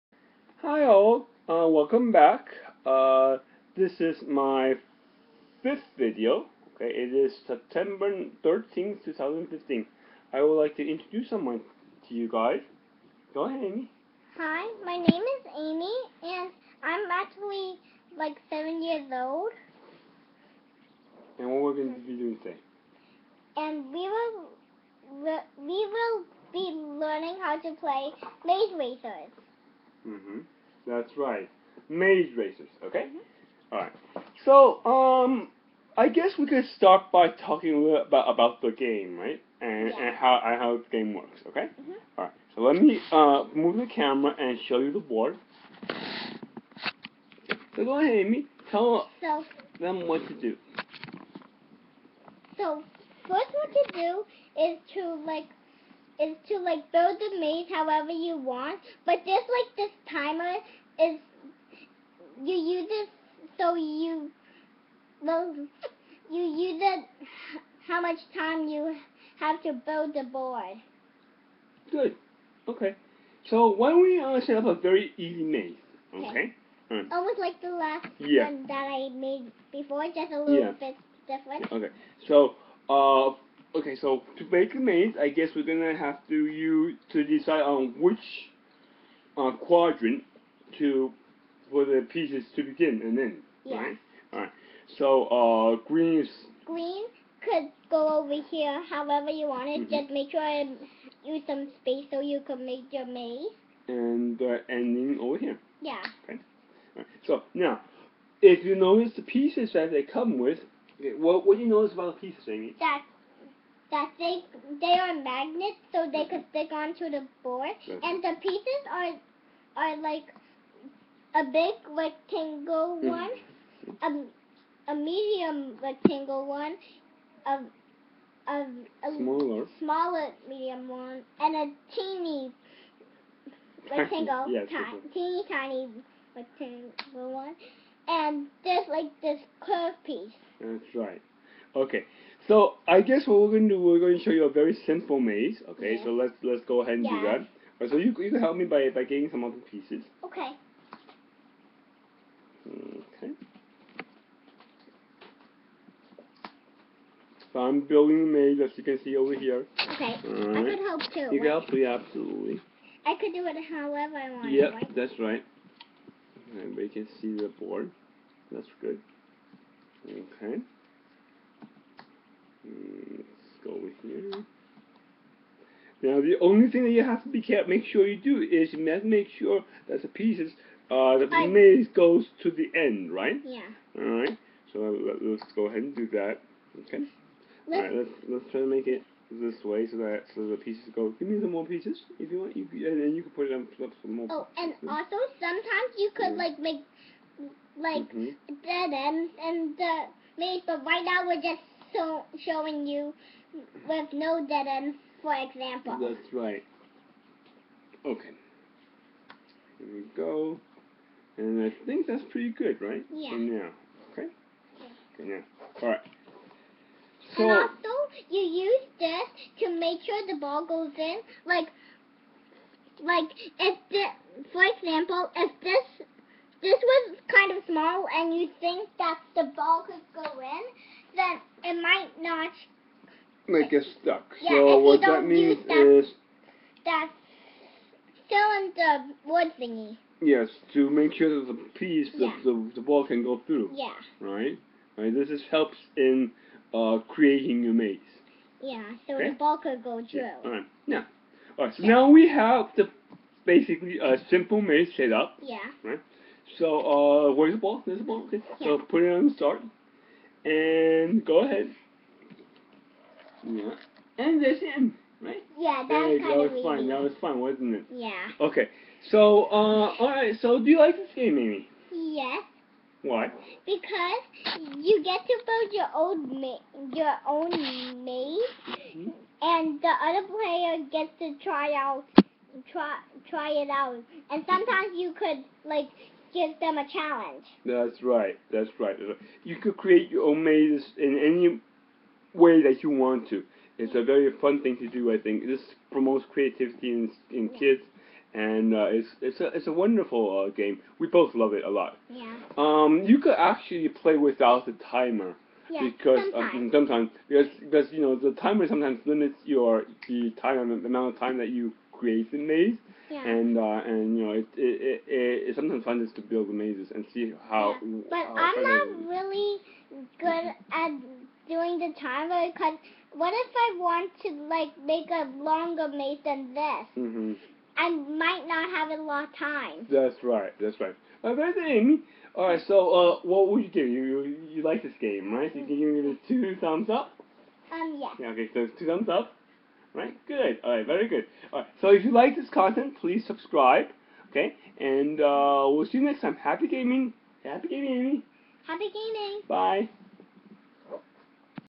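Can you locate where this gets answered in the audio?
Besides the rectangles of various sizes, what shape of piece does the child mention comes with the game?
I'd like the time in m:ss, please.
2:19.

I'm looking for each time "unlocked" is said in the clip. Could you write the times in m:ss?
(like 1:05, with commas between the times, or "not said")
not said.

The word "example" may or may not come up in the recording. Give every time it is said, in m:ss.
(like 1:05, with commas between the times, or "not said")
3:25, 3:44.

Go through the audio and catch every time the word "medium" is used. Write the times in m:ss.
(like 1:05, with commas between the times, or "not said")
2:04, 2:10.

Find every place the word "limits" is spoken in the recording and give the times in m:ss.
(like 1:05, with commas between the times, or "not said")
5:09.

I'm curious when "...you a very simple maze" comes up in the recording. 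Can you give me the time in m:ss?
2:24.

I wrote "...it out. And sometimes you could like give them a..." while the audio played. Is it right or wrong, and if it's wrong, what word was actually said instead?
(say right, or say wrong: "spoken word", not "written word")
right.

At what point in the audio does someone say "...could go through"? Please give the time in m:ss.
4:09.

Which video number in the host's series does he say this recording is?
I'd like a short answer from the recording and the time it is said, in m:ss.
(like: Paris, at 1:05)
5th, at 0:05.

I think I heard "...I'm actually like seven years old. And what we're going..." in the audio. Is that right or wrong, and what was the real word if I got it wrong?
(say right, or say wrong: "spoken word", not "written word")
right.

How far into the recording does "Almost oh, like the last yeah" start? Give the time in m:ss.
1:17.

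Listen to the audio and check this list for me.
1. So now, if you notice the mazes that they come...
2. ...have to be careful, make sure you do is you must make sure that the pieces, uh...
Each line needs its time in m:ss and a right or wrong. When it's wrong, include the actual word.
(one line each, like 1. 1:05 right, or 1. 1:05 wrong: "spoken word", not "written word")
1. 1:47 wrong: "pieces", not "mazes"
2. 2:57 right.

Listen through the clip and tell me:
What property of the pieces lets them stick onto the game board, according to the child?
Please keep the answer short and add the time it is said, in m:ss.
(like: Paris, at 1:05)
Magnets, at 1:55.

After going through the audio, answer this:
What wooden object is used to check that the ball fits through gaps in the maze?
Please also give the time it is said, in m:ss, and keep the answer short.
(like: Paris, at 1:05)
Cylinder, at 3:58.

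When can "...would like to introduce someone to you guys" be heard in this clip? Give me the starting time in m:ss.
0:10.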